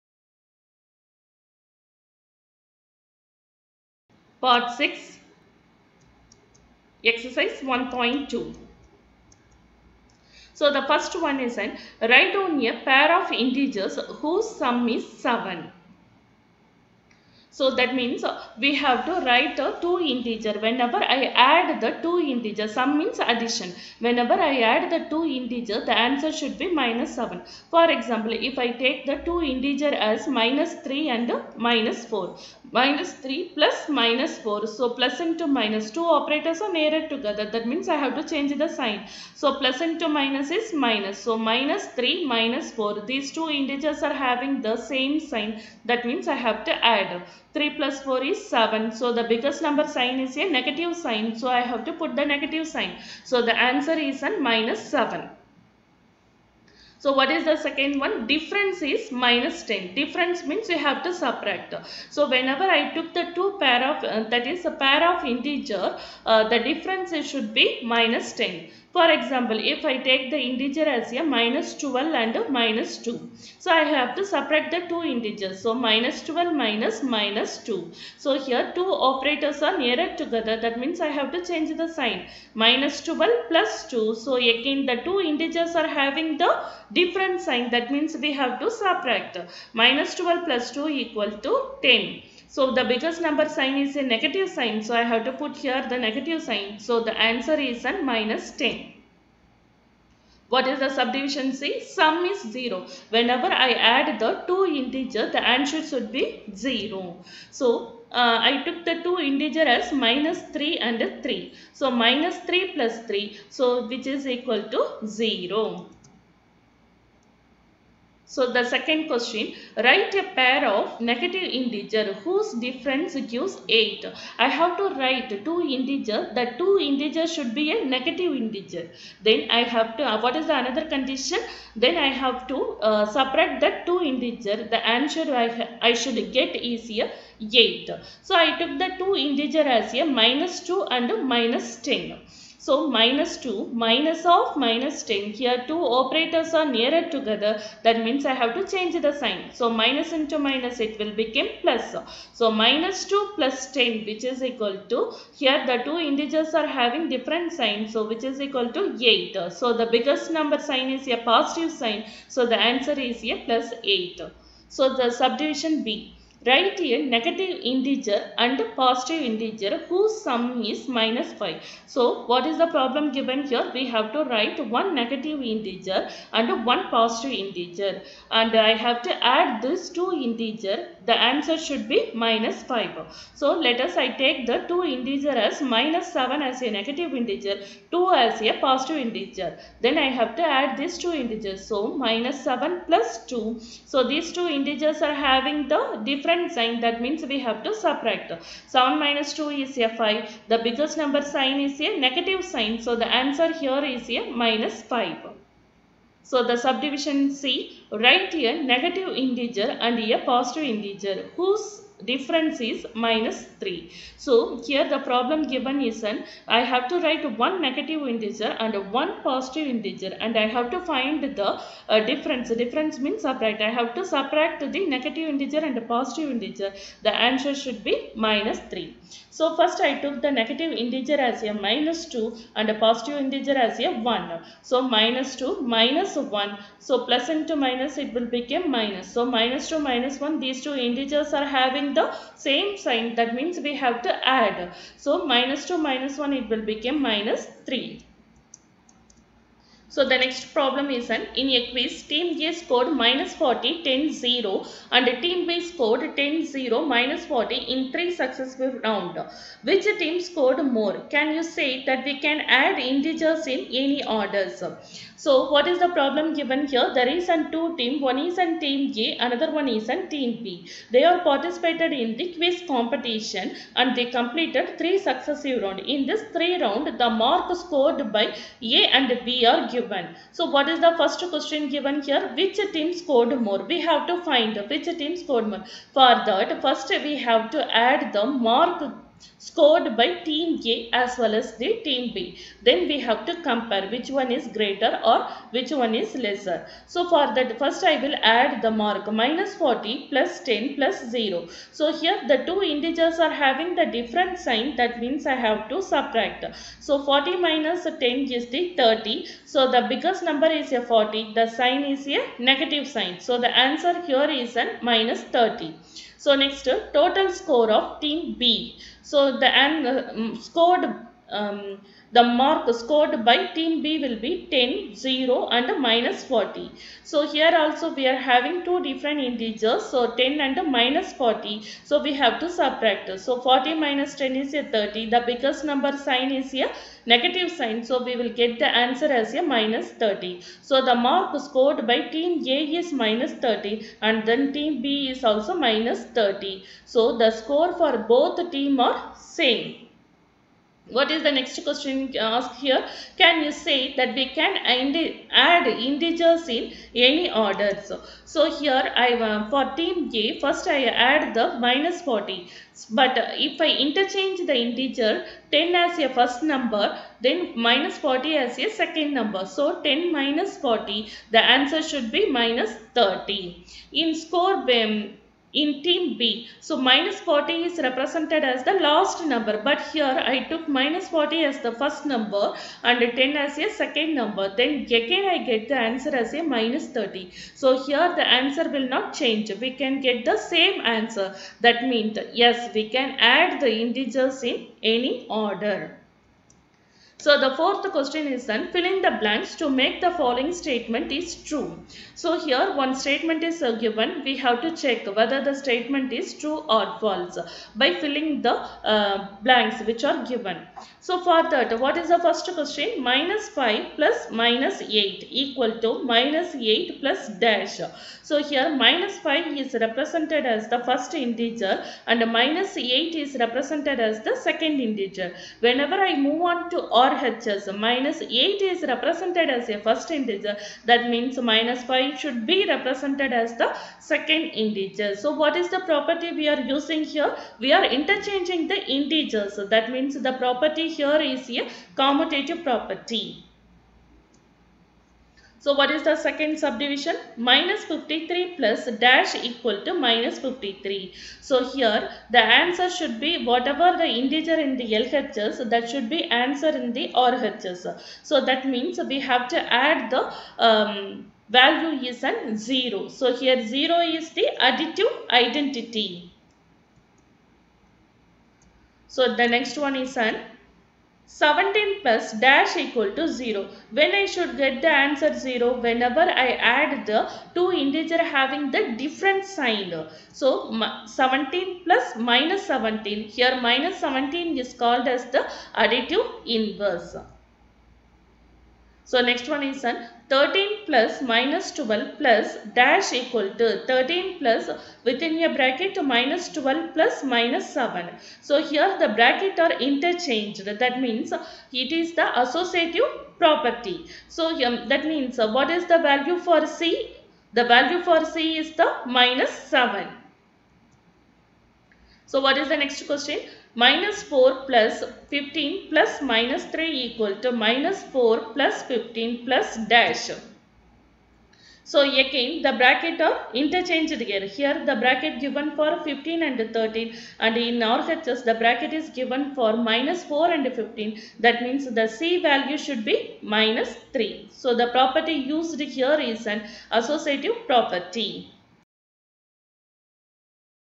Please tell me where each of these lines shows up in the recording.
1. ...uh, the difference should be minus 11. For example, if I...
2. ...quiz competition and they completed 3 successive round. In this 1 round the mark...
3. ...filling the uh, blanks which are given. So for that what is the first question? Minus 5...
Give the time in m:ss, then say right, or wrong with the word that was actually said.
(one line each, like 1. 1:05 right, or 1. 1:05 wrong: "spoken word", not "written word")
1. 1:06 wrong: "10", not "11"
2. 4:32 wrong: "3", not "1"
3. 6:48 right.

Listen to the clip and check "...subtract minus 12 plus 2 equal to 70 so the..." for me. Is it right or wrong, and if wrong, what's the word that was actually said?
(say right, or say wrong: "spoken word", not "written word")
wrong: "10", not "70".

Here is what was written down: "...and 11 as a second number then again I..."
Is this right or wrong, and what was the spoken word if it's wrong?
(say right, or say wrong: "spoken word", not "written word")
wrong: "10", not "11".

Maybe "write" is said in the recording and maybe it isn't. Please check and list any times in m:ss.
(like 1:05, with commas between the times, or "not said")
0:12, 0:19, 1:59, 2:04, 2:46, 2:54, 3:27, 3:37.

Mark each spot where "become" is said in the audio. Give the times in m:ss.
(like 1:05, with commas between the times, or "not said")
2:31, 3:58, 4:06.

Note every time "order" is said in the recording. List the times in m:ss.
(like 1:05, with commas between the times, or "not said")
4:24, 5:57, 6:35.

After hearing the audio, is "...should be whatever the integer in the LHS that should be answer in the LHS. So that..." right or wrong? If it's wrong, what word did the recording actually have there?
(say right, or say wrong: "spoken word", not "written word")
wrong: "RHS", not "LHS".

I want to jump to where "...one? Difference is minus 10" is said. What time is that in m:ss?
0:57.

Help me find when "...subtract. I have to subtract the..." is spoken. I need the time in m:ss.
3:43.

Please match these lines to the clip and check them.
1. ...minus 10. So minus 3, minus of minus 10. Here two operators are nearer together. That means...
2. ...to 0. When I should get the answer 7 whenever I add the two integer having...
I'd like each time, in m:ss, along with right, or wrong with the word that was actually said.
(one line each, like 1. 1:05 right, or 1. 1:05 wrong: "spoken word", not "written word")
1. 2:21 wrong: "2", not "3"
2. 7:53 wrong: "0", not "7".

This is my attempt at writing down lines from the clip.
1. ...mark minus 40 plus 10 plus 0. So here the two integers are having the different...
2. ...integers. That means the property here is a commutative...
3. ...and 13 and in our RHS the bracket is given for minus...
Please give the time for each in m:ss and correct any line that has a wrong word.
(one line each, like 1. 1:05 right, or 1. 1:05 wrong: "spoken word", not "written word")
1. 4:58 right
2. 7:18 right
3. 8:46 right.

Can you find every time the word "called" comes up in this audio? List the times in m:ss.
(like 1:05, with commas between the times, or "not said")
8:04.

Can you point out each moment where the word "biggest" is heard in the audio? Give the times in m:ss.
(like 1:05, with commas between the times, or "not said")
0:49, 1:32, 2:39, 3:20, 5:09, 5:35.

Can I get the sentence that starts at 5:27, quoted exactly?
So here also we are having two different integers.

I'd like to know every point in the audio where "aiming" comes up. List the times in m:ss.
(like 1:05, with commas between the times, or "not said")
not said.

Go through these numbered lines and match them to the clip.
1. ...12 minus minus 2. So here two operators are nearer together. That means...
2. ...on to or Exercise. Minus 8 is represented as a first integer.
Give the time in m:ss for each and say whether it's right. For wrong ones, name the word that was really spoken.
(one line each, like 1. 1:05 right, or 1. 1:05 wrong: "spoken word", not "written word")
1. 1:16 right
2. 7:06 wrong: "RHS", not "Exercise".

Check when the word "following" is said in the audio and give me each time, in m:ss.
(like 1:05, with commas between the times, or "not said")
6:40.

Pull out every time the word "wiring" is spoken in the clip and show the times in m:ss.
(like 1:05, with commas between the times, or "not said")
not said.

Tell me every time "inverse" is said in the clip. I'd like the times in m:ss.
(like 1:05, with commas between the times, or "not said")
8:06.